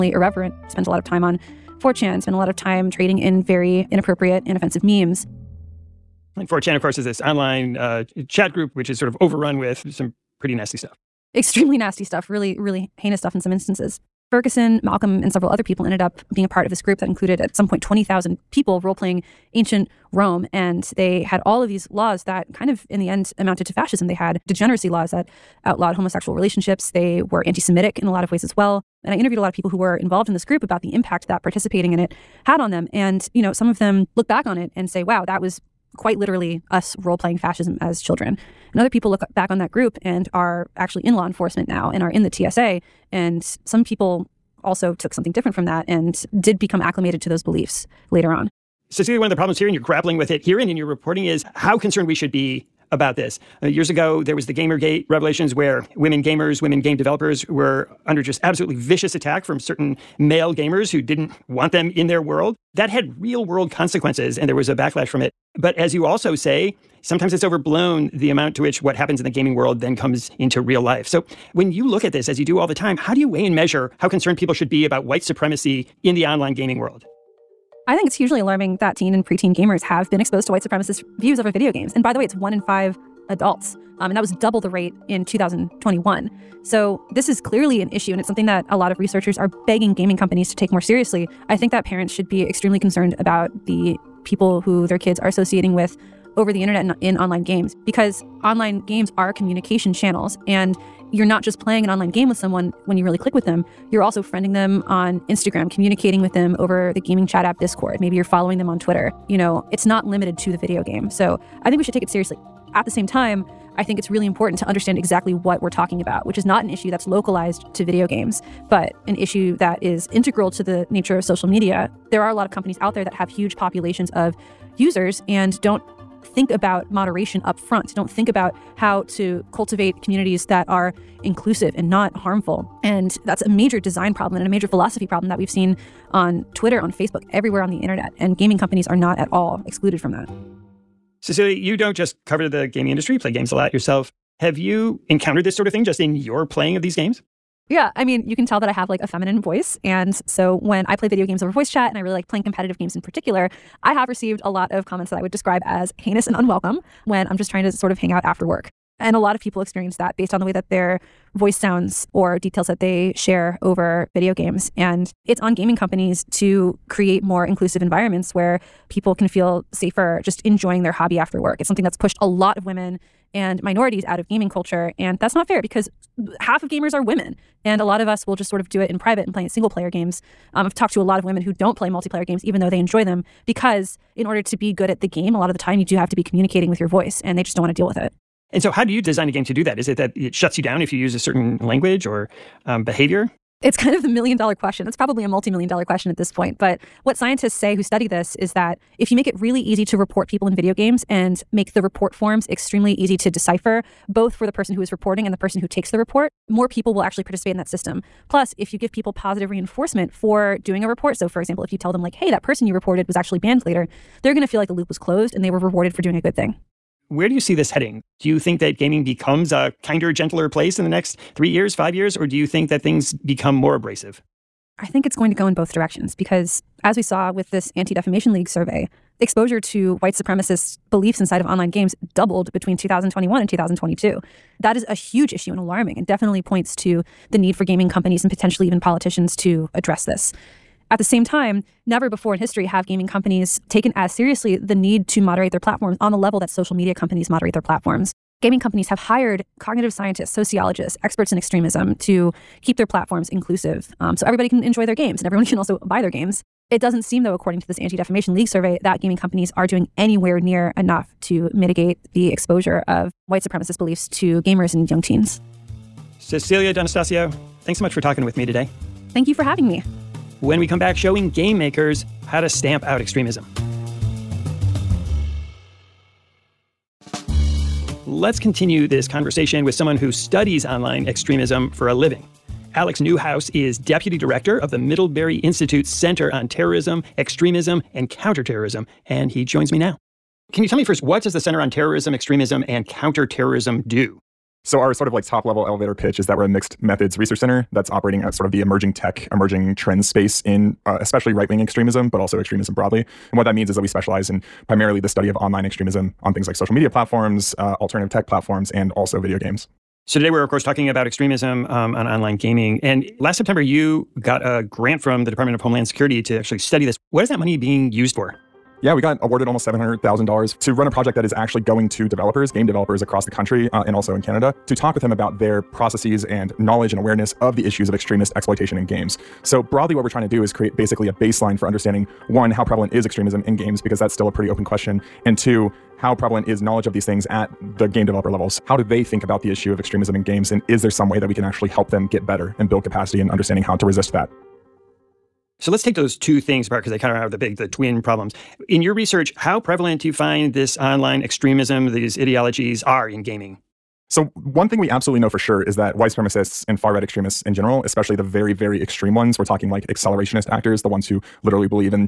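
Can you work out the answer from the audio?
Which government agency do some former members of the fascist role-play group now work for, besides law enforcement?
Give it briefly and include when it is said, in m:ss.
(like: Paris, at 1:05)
TSA, at 0:42.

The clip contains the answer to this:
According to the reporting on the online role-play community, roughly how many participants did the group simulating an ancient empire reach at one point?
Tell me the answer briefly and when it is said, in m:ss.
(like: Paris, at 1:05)
20,000, at 0:17.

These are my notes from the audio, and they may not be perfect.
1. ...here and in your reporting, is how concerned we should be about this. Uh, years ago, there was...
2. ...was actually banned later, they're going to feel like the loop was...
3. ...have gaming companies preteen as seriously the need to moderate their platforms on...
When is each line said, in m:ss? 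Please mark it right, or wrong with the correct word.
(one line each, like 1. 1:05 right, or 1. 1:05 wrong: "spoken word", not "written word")
1. 0:50 right
2. 3:33 right
3. 4:02 wrong: "taken", not "preteen".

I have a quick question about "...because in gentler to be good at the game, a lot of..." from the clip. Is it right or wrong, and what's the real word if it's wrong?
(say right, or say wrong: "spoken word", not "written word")
wrong: "order", not "gentler".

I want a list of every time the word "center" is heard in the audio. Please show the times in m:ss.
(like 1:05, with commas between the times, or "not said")
4:45, 4:51, 4:57.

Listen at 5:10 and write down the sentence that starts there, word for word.
So, today we're, of course, talking about extremism um, on online gaming.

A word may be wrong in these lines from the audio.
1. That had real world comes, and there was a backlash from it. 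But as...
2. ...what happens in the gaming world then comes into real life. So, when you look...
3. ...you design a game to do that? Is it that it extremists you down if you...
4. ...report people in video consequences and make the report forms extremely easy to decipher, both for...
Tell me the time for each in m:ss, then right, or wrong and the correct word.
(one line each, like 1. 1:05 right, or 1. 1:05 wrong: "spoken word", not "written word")
1. 1:02 wrong: "consequences", not "comes"
2. 1:08 right
3. 3:08 wrong: "shuts", not "extremists"
4. 3:19 wrong: "games", not "consequences".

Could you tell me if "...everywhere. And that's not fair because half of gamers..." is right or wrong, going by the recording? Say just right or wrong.
wrong.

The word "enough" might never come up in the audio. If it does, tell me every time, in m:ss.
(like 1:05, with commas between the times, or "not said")
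4:20.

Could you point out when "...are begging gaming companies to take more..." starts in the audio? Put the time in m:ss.
1:29.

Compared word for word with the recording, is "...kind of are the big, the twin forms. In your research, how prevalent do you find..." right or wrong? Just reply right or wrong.
wrong.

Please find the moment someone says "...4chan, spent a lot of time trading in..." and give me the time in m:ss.
0:01.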